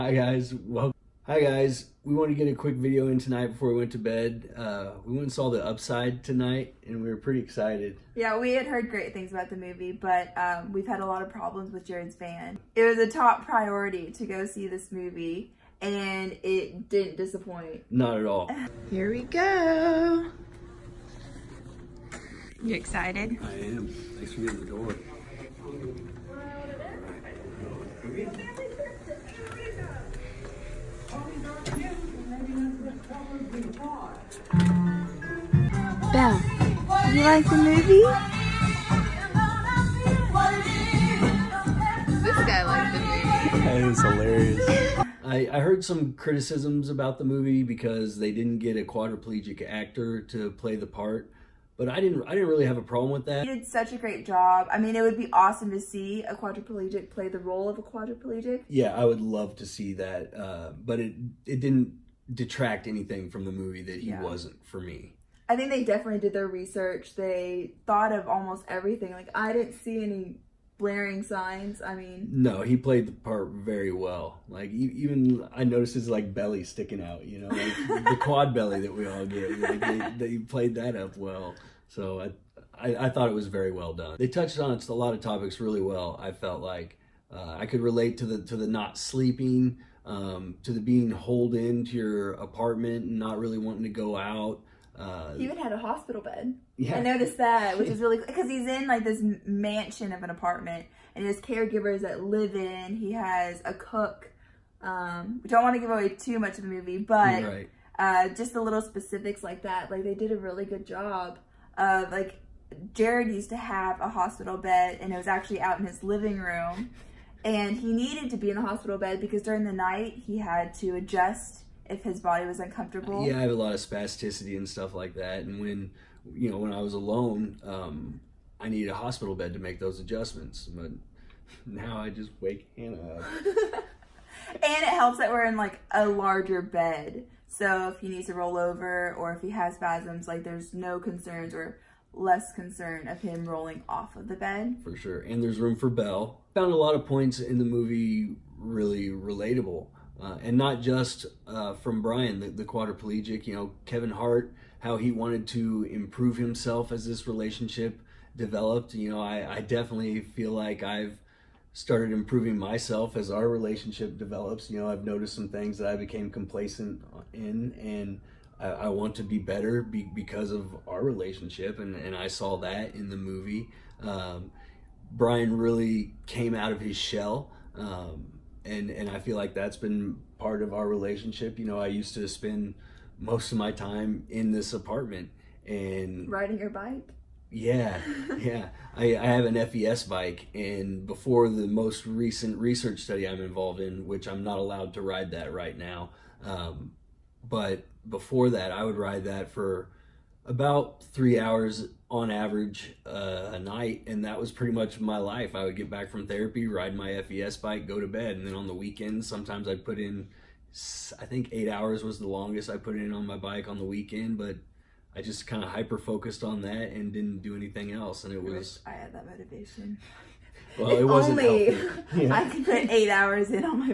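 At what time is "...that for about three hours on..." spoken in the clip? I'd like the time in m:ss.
3:19.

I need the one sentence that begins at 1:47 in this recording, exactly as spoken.
uh, just the little specifics like that.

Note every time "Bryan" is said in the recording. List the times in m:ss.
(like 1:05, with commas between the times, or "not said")
2:32, 2:55.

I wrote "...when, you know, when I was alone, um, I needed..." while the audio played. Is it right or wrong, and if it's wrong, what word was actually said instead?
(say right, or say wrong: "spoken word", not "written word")
right.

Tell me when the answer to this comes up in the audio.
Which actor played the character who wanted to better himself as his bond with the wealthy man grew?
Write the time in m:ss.
2:33.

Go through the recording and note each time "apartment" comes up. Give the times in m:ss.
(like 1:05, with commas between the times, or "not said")
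1:32, 1:40, 3:04.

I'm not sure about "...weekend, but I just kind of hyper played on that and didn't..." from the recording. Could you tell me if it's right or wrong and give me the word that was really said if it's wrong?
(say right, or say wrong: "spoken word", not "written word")
wrong: "focused", not "played".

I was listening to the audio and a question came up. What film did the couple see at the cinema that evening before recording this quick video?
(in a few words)
The Upside.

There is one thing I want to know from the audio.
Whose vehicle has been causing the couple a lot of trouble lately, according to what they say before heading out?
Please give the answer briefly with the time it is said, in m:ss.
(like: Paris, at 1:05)
Jared's van, at 0:11.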